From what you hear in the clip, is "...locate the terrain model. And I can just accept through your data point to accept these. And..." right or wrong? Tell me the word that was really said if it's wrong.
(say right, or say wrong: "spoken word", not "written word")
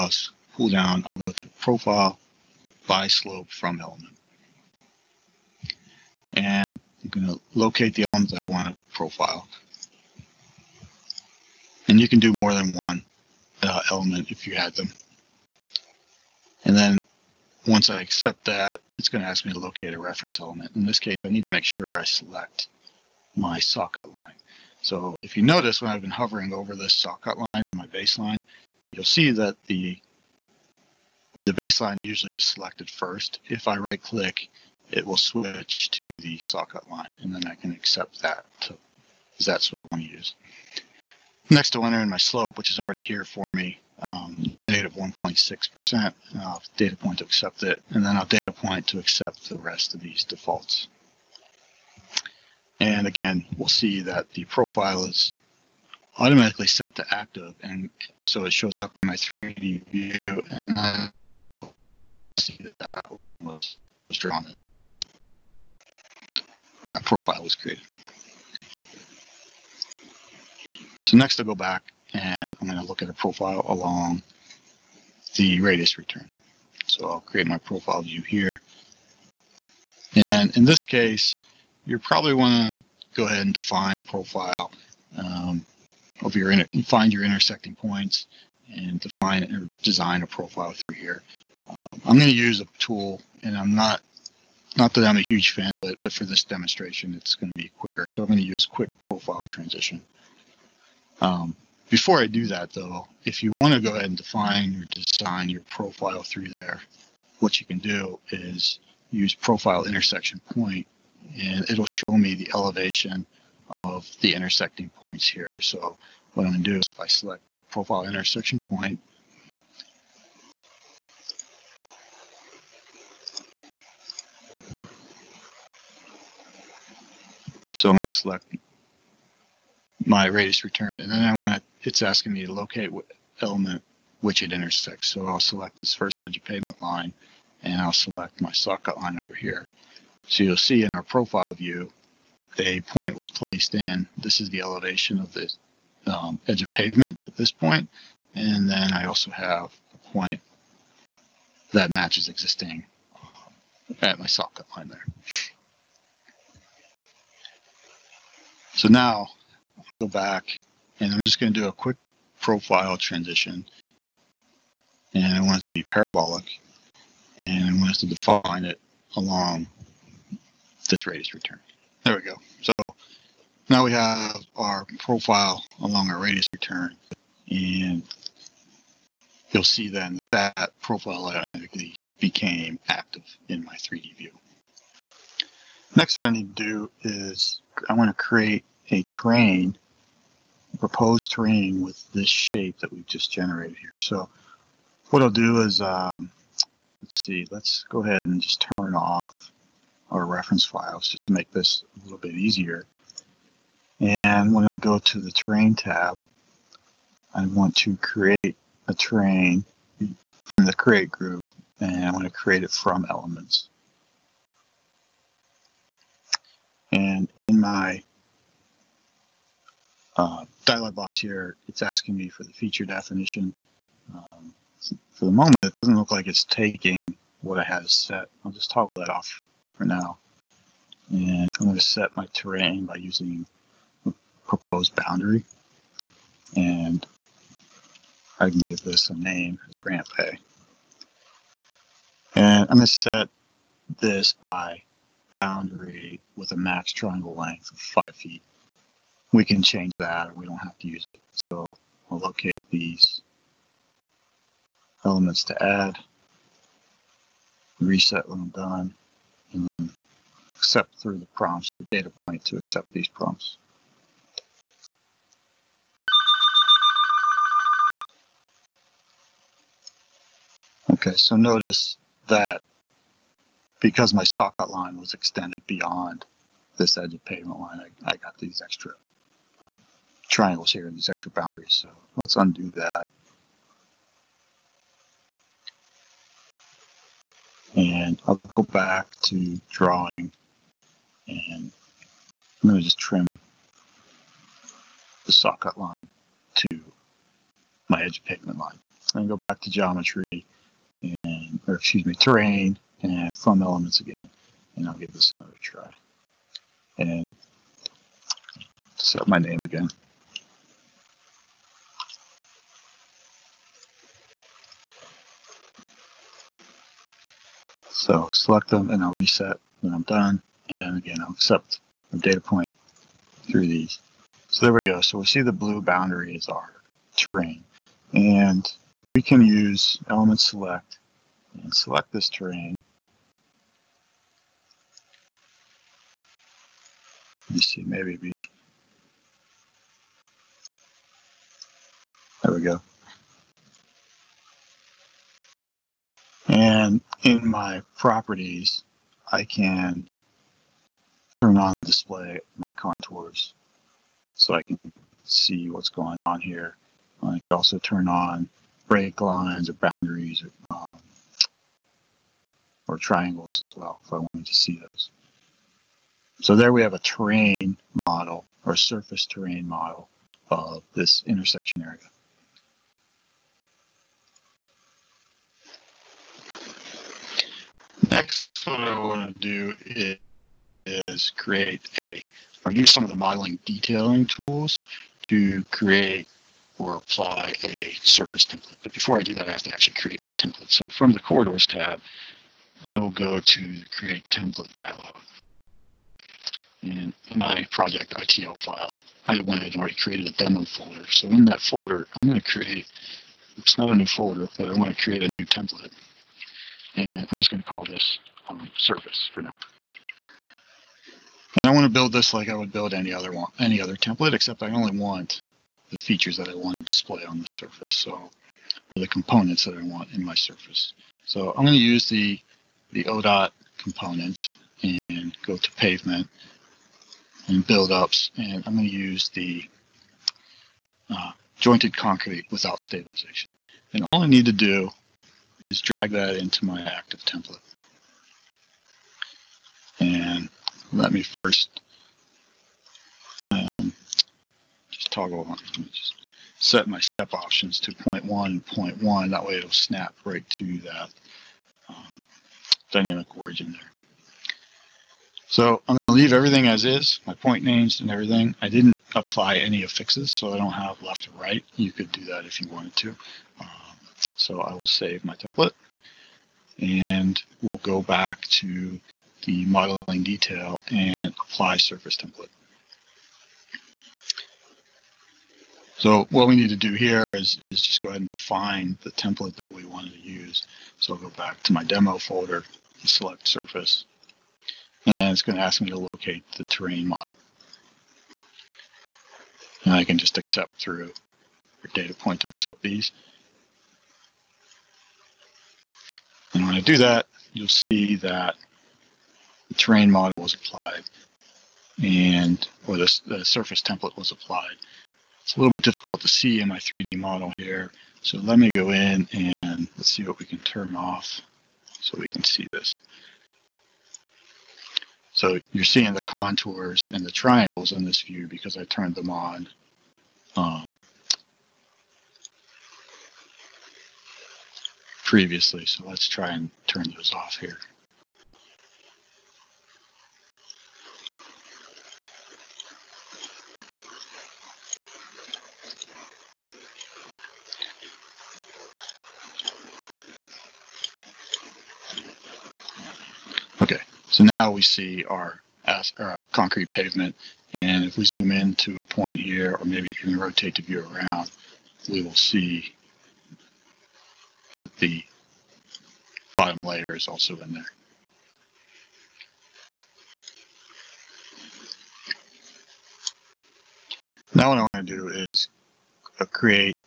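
right.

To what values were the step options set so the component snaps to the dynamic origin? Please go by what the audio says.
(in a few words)
0.1 0.1.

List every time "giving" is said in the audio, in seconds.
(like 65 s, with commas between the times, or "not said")
not said.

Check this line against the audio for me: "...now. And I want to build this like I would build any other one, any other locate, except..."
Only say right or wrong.
wrong.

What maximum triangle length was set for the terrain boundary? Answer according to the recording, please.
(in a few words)
5 feet.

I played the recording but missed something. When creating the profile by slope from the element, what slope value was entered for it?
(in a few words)
-1.6%.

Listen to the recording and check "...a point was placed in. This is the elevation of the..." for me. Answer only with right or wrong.
right.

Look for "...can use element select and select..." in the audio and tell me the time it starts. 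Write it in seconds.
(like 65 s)
329 s.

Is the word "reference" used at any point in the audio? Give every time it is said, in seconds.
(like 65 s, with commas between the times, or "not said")
20 s, 200 s.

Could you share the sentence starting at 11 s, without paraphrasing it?
And you can do more than one uh, element if you had them.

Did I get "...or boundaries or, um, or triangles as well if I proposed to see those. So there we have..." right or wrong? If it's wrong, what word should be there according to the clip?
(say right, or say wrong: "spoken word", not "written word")
wrong: "wanted", not "proposed".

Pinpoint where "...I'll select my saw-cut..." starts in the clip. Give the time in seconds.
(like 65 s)
137 s.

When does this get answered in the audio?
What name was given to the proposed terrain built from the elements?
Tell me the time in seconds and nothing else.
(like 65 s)
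239 s.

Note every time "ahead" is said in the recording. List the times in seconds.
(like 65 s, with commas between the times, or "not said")
83 s, 103 s, 198 s, 478 s.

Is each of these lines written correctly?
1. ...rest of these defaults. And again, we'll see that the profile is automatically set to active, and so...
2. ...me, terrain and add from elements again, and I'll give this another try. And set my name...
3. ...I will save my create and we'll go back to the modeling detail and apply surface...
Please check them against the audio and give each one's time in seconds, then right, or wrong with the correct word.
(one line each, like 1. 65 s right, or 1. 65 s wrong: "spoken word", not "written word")
1. 49 s right
2. 302 s right
3. 464 s wrong: "template", not "create".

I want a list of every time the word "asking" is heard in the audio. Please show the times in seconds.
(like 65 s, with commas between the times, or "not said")
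132 s, 221 s.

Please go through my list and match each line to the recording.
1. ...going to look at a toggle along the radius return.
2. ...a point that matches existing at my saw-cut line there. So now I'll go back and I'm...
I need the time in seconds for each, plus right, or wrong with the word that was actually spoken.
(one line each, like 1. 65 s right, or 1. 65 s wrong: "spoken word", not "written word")
1. 72 s wrong: "profile", not "toggle"
2. 149 s right.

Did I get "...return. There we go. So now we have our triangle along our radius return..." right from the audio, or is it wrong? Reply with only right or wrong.
wrong.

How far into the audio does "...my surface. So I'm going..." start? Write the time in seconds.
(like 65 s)
420 s.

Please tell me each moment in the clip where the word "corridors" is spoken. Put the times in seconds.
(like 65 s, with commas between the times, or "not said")
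391 s.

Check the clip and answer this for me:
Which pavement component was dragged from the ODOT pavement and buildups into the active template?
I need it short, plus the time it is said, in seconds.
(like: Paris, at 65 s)
jointed concrete without stabilization, at 431 s.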